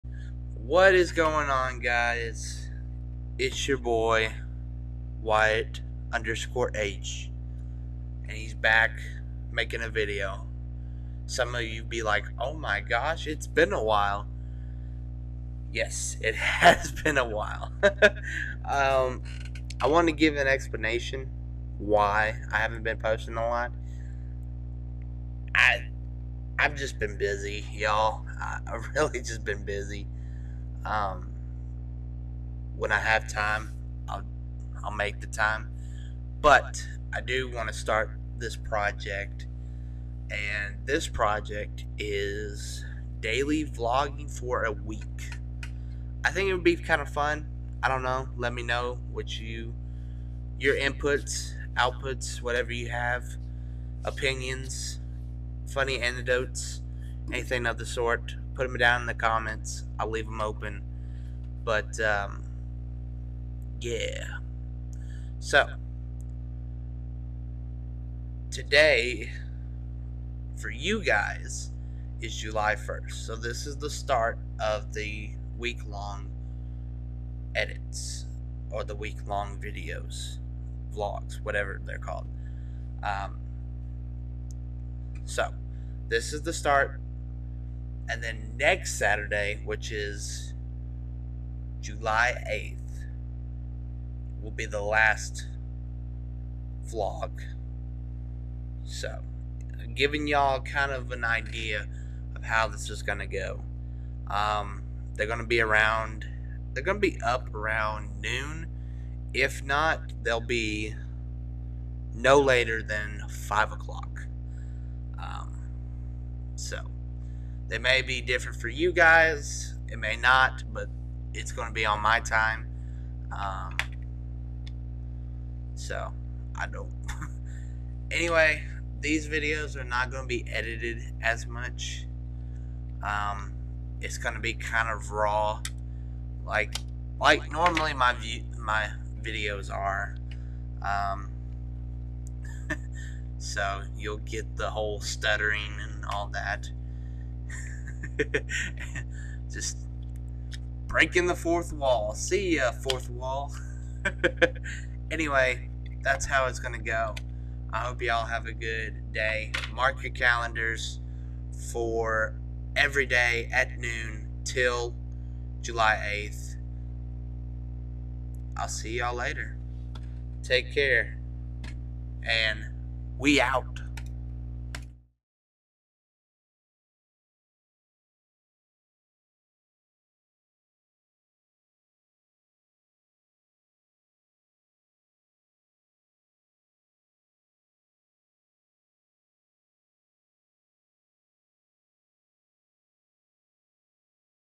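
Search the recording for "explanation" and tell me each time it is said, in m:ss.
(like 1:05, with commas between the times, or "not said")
0:20.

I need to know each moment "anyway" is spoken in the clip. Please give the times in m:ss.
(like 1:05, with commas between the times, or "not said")
2:08, 2:35.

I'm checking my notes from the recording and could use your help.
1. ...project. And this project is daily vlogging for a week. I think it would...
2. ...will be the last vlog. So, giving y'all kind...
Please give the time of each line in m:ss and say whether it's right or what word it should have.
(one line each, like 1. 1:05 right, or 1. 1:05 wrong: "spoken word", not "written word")
1. 0:38 right
2. 1:34 right.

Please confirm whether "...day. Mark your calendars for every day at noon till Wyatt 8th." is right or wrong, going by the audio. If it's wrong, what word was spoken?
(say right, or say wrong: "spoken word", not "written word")
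wrong: "July", not "Wyatt".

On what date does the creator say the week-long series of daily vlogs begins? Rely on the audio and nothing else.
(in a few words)
July 1st.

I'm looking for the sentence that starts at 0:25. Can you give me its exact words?
I I've just been busy, y'all.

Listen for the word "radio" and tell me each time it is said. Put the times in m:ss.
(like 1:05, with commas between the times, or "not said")
not said.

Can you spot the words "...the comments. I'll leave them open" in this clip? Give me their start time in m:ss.
0:59.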